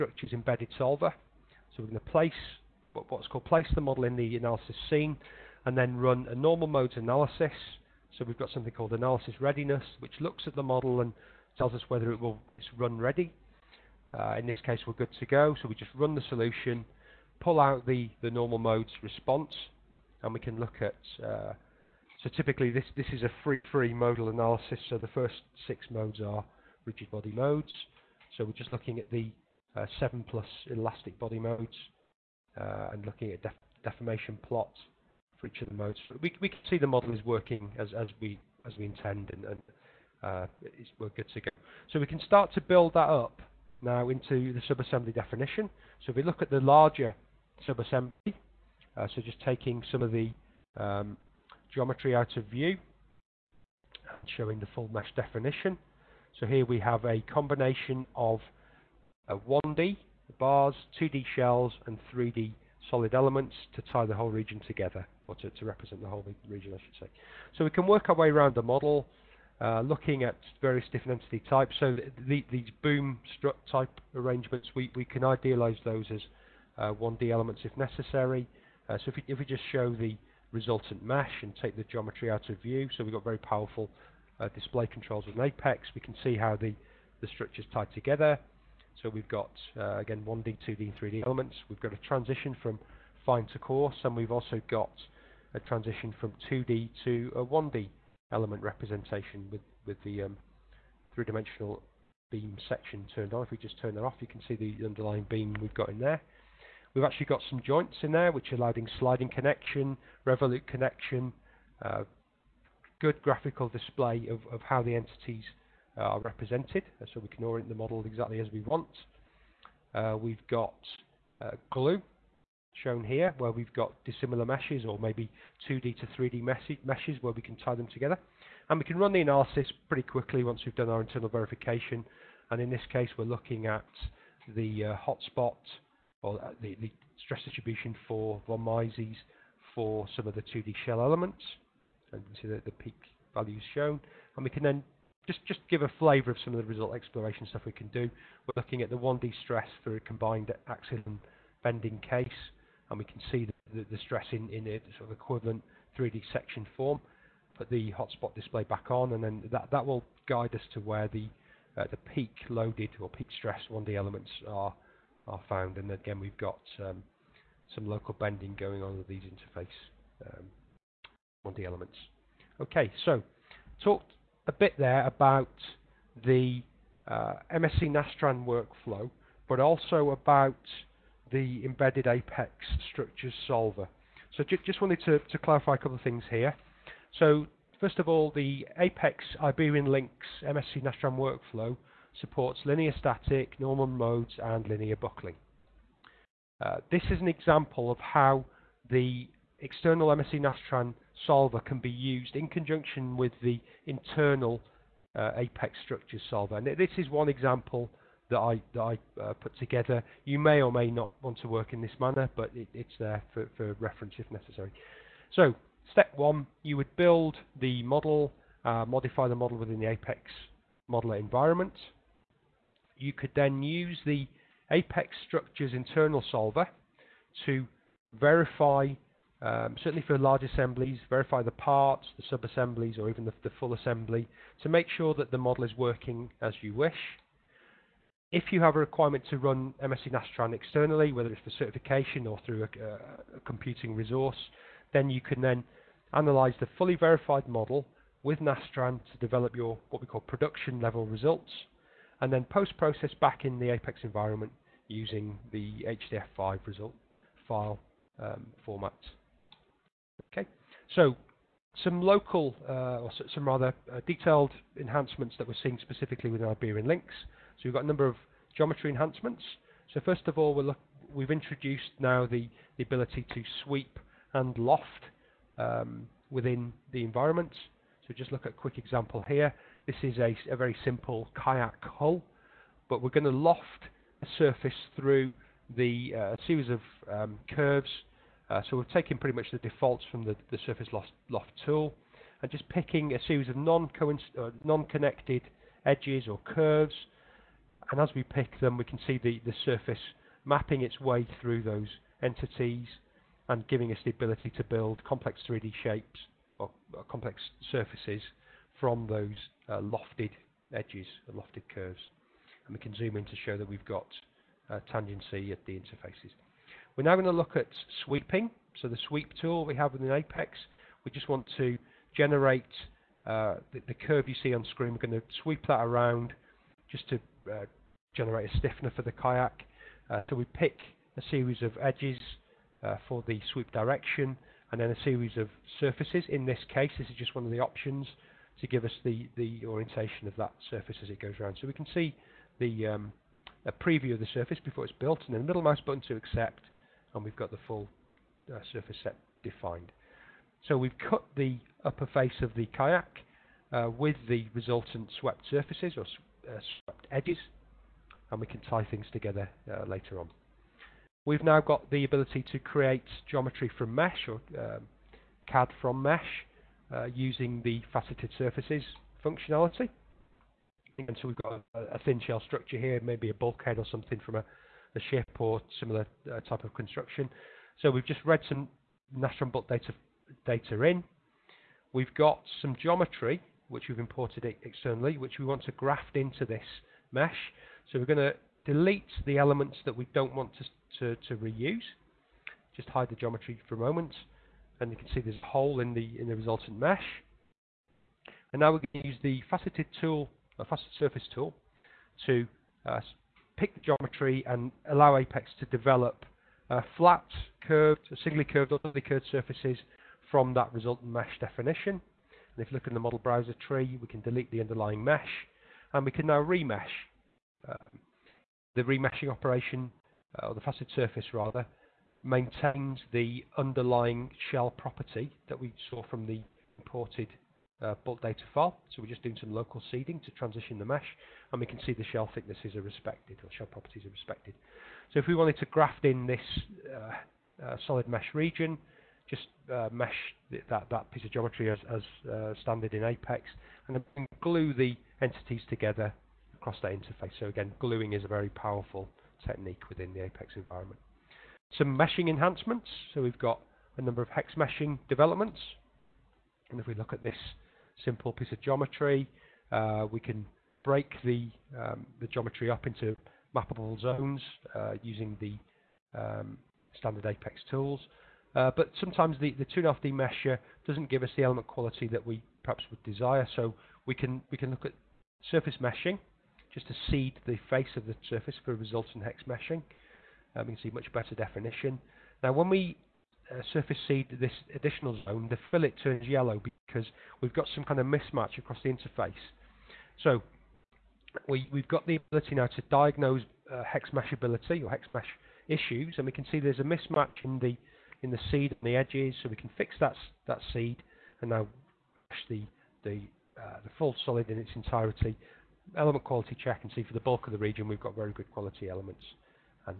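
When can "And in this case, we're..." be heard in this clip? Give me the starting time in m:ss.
2:12.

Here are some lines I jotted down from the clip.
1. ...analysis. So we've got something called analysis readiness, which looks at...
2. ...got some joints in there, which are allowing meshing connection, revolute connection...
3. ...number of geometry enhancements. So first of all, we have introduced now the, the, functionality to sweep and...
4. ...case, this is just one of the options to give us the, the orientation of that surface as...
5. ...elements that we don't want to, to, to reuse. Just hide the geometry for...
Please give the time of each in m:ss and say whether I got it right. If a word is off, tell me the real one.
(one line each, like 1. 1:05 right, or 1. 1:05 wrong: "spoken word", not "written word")
1. 0:06 right
2. 1:47 wrong: "sliding", not "meshing"
3. 4:27 wrong: "ability", not "functionality"
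4. 5:36 right
5. 6:29 right.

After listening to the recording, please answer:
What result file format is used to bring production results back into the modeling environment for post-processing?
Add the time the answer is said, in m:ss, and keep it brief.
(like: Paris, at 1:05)
HDF5, at 4:16.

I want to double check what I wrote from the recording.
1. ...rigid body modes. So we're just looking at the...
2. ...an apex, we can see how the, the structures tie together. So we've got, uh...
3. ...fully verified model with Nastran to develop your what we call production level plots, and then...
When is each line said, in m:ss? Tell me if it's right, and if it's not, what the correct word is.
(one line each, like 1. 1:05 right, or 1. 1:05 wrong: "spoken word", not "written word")
1. 0:26 right
2. 1:25 right
3. 4:06 wrong: "results", not "plots".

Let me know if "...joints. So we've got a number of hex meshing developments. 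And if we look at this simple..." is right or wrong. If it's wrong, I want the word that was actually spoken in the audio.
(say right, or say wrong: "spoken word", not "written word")
wrong: "enhancements", not "joints".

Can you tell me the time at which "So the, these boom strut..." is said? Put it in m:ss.
1:11.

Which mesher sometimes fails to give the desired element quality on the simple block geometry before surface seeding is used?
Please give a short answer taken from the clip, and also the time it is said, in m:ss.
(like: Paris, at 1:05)
2.5D mesher, at 7:49.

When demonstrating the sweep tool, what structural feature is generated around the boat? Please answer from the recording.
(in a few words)
A stiffener.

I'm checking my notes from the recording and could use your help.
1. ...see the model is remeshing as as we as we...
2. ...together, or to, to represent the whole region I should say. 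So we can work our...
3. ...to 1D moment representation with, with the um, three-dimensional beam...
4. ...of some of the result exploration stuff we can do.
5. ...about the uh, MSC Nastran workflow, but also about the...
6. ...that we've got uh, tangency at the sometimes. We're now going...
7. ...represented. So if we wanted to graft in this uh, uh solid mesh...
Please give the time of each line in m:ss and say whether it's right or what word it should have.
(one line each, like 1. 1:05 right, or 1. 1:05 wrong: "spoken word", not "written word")
1. 0:36 wrong: "working", not "remeshing"
2. 1:04 right
3. 1:37 wrong: "element", not "moment"
4. 2:26 right
5. 2:55 right
6. 5:13 wrong: "interfaces", not "sometimes"
7. 7:14 wrong: "respected", not "represented".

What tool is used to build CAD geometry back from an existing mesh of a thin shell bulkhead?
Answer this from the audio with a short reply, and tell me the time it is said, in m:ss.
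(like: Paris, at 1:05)
Faceted surface tool, at 6:40.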